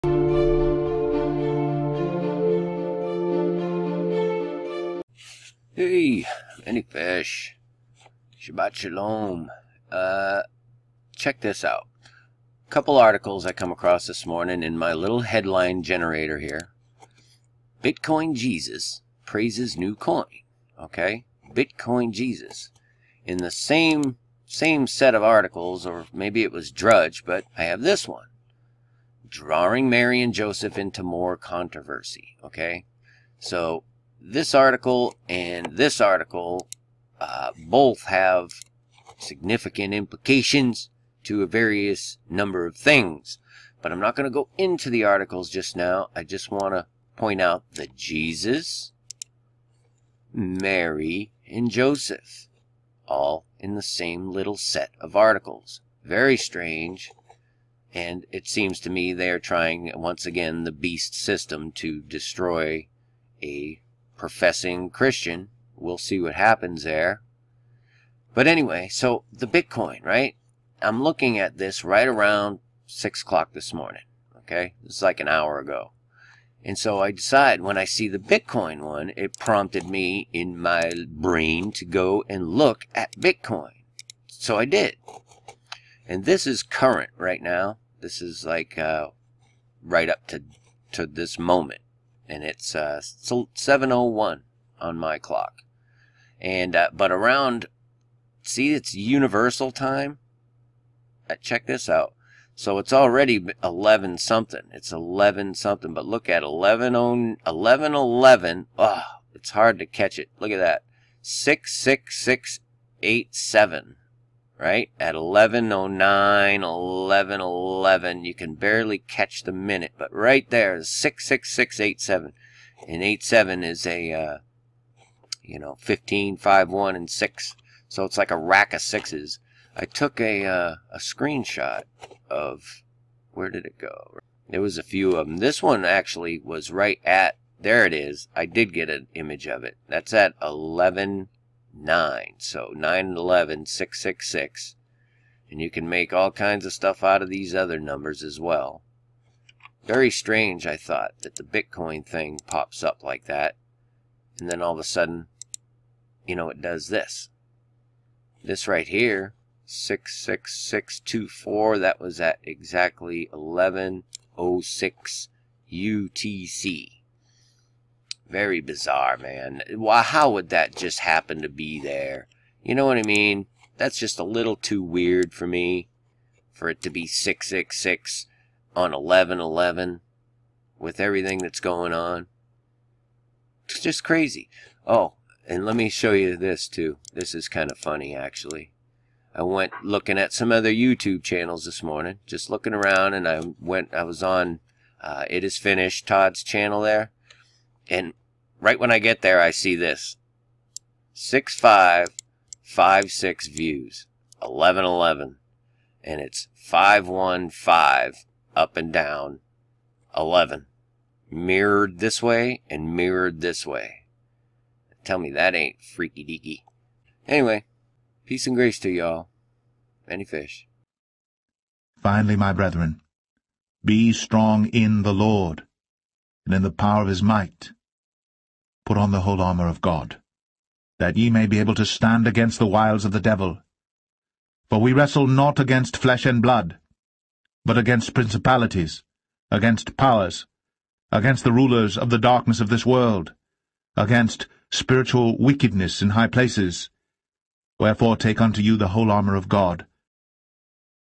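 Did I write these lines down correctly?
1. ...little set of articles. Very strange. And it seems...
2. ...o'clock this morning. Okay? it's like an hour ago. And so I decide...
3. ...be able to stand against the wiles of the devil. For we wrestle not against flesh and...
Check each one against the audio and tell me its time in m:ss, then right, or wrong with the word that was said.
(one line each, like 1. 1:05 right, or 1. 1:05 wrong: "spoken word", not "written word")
1. 0:54 right
2. 1:13 right
3. 3:51 right.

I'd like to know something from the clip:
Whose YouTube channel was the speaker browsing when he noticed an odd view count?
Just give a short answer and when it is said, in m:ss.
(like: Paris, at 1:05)
Todd, at 3:16.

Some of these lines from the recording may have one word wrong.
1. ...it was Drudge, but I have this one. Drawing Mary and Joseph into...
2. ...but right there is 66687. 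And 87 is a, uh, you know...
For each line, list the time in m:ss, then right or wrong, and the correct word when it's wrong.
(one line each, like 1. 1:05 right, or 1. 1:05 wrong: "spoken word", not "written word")
1. 0:26 right
2. 1:59 right.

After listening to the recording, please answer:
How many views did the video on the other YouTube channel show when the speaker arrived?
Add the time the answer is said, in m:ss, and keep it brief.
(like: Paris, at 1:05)
6556, at 3:21.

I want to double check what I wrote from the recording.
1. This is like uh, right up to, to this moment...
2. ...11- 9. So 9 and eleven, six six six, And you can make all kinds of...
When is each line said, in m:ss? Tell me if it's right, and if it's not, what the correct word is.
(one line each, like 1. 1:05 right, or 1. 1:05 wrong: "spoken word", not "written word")
1. 1:28 right
2. 2:20 right.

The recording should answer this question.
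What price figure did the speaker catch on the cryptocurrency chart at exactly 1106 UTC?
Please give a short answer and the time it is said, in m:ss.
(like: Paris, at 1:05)
66624, at 2:39.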